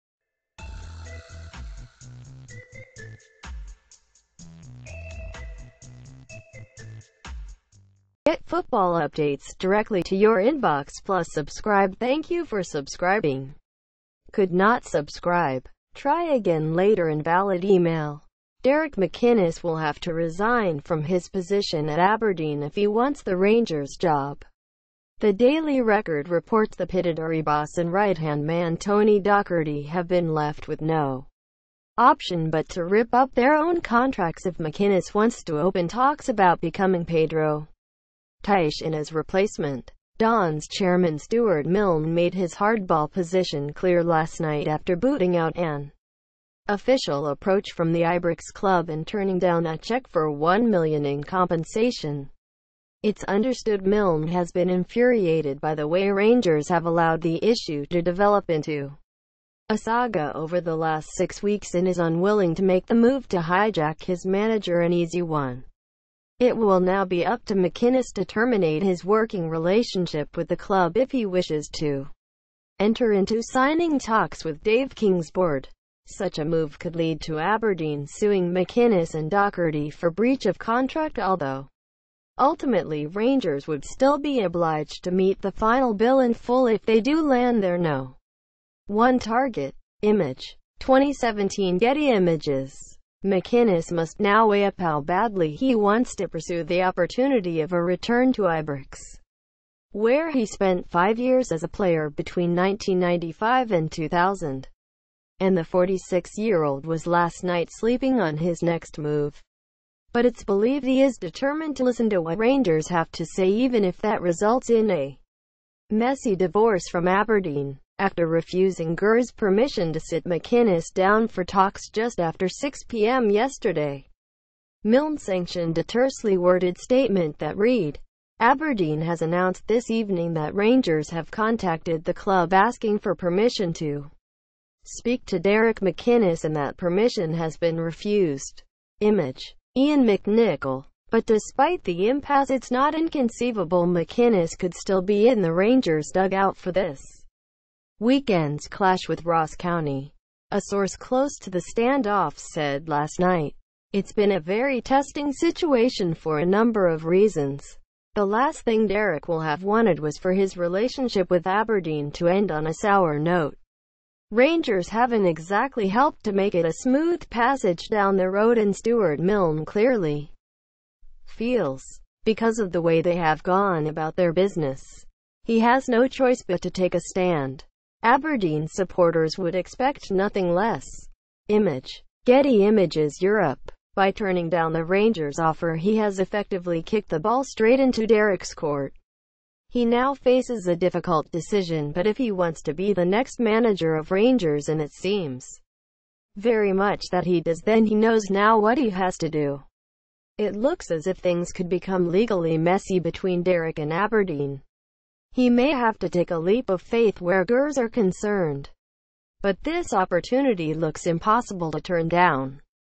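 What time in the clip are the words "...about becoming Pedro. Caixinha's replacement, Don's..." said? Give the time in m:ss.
0:36.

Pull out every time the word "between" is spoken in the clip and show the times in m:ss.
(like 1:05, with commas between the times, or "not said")
1:42, 3:22.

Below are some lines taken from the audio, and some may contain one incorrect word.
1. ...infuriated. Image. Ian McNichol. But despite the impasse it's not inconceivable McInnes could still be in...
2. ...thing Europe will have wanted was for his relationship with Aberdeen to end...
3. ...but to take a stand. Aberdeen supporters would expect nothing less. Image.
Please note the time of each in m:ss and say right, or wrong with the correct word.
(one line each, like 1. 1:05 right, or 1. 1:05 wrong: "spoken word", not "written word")
1. 2:17 wrong: "refused", not "infuriated"
2. 2:38 wrong: "Derek", not "Europe"
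3. 2:56 right.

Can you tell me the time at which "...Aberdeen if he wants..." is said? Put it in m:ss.
0:21.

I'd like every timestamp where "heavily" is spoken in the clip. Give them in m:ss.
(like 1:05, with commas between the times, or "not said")
not said.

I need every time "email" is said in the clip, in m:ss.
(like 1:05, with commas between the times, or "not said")
0:17.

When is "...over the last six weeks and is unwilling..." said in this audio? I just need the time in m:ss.
1:00.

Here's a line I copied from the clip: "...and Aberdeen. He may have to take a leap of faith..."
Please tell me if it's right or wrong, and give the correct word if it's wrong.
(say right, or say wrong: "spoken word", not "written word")
right.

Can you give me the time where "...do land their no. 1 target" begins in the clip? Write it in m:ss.
1:27.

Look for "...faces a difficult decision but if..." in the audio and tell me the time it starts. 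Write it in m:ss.
3:10.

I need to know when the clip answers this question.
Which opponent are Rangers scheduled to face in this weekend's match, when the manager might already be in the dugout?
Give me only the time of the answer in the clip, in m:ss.
2:29.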